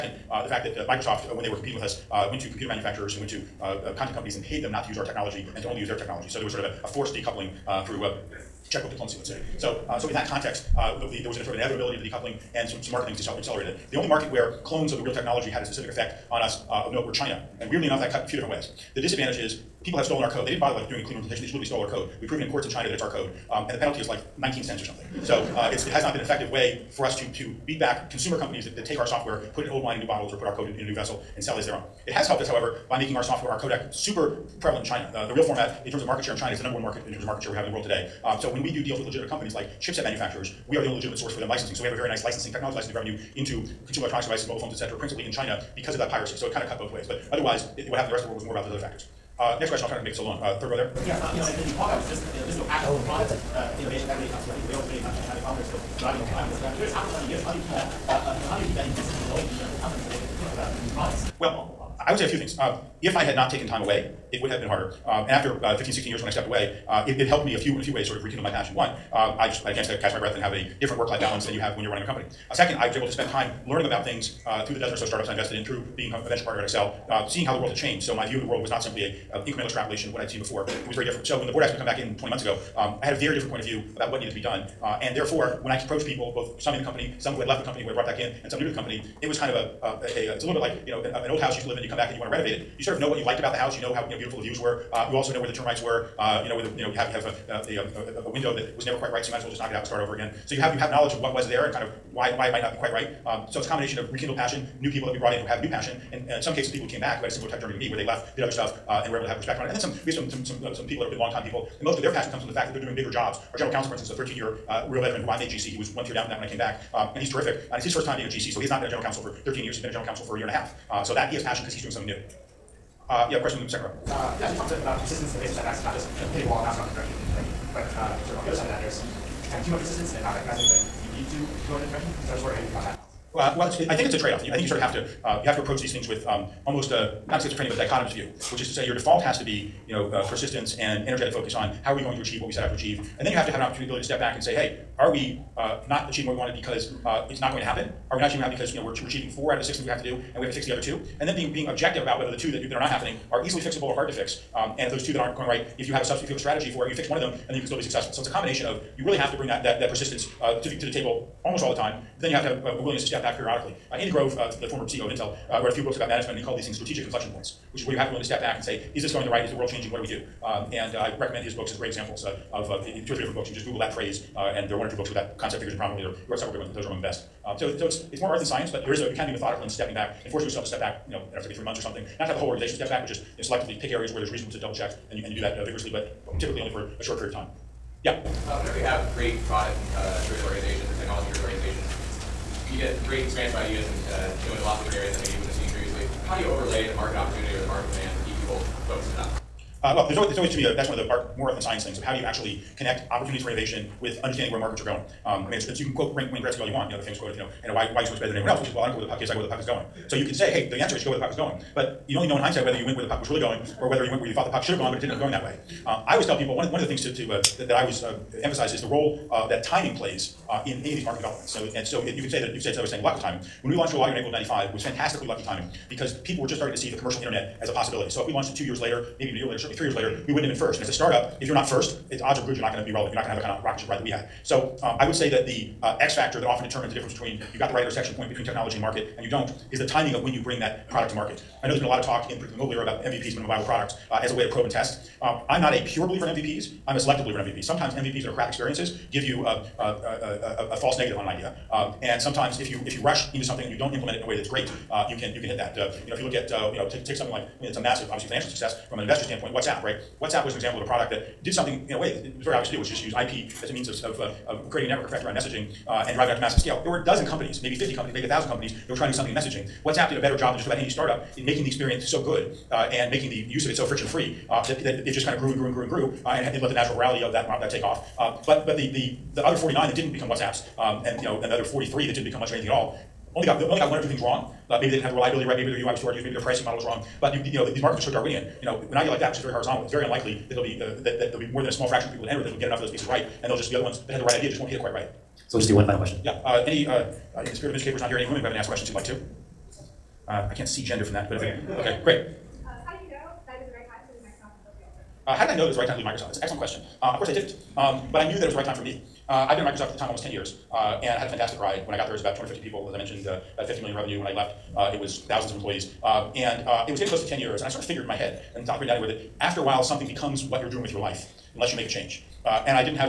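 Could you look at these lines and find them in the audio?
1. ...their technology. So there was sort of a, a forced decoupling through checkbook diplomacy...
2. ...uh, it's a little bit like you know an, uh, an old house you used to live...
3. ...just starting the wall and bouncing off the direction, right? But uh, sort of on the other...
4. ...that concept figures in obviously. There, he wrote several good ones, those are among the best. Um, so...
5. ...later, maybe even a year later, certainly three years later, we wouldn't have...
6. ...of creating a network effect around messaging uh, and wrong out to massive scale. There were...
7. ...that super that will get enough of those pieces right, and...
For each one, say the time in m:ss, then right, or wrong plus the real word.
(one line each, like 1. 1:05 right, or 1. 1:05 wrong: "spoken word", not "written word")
1. 0:05 right
2. 1:30 right
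3. 2:05 wrong: "hitting", not "starting"
4. 2:55 wrong: "prominently", not "obviously"
5. 3:48 right
6. 4:24 wrong: "driving", not "wrong"
7. 4:52 wrong: "enter", not "super".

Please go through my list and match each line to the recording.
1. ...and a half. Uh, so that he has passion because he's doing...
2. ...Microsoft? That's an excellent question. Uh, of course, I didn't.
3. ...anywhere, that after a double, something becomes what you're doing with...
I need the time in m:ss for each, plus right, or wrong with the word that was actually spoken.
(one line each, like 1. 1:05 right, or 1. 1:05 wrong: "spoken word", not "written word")
1. 2:00 right
2. 5:06 right
3. 5:18 wrong: "while", not "double".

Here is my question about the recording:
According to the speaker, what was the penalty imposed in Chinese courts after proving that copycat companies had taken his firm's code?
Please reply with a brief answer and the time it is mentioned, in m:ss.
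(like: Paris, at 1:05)
19 cents, at 0:24.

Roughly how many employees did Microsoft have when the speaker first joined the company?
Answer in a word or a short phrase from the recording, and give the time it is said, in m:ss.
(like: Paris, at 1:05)
250, at 5:12.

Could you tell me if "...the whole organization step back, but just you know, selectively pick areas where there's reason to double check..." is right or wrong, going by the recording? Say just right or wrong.
right.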